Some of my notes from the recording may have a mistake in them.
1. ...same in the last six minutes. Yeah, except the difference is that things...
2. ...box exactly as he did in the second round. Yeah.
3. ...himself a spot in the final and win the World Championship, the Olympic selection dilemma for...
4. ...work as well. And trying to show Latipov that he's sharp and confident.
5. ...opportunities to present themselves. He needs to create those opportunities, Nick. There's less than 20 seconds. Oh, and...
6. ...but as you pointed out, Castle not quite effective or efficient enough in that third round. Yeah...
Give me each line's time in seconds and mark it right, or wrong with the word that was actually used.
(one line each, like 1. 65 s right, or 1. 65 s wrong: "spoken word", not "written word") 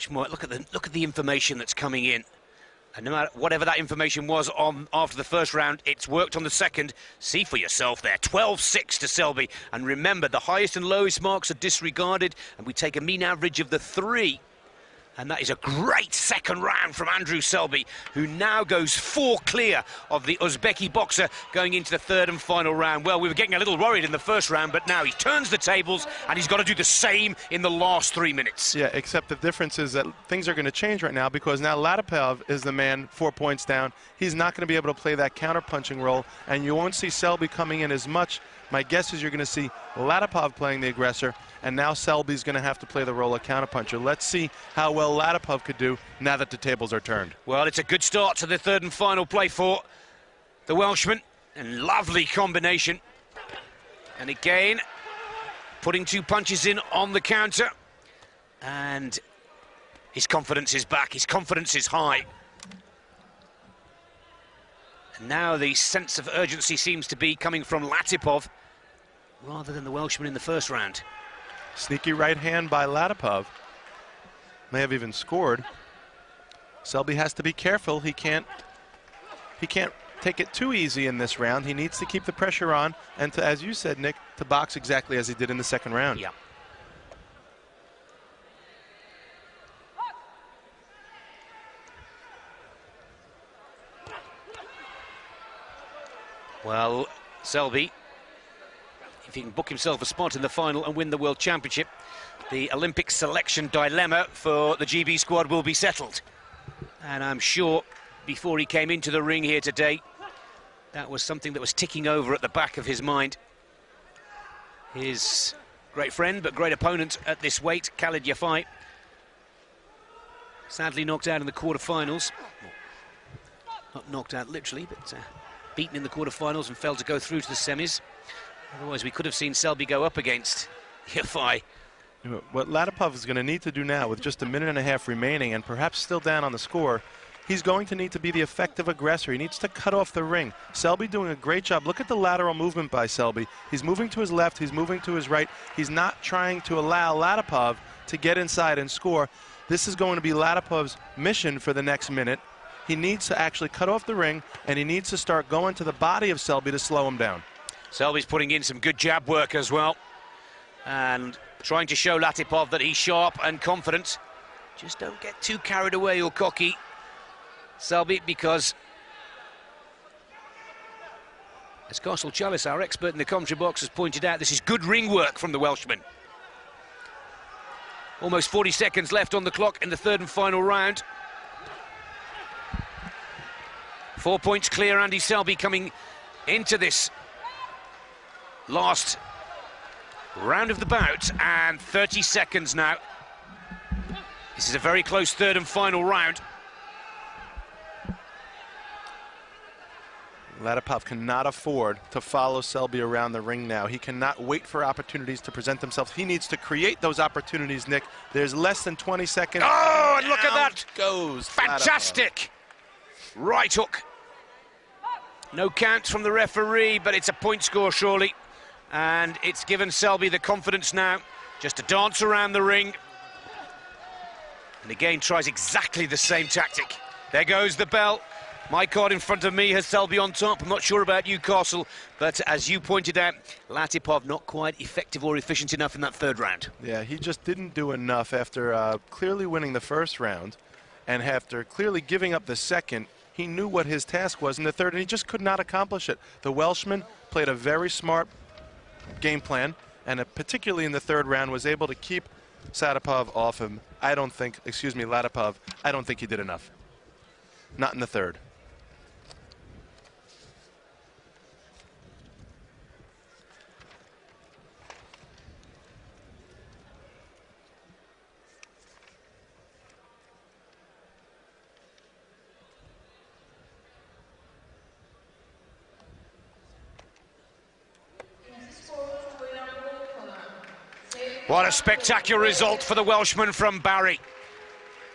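1. 26 s wrong: "three", not "six"
2. 84 s right
3. 99 s right
4. 159 s right
5. 204 s right
6. 232 s wrong: "Latipov", not "Castle".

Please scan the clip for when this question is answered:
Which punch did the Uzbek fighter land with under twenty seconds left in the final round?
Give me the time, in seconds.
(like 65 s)
213 s.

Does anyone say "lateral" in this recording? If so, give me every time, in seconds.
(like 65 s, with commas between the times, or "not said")
142 s.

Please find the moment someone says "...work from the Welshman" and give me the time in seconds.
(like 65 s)
175 s.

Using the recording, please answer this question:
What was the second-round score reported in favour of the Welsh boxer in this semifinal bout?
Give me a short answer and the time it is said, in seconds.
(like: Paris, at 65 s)
12-6, at 8 s.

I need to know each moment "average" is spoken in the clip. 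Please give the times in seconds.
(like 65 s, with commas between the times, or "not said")
13 s.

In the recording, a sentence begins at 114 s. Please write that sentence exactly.
His great friend but great opponent at this weight, Khalid Yafai, sadly knocked out in the quarterfinals.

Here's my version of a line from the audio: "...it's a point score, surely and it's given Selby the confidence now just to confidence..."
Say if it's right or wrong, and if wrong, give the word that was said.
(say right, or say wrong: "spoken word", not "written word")
wrong: "dance", not "confidence".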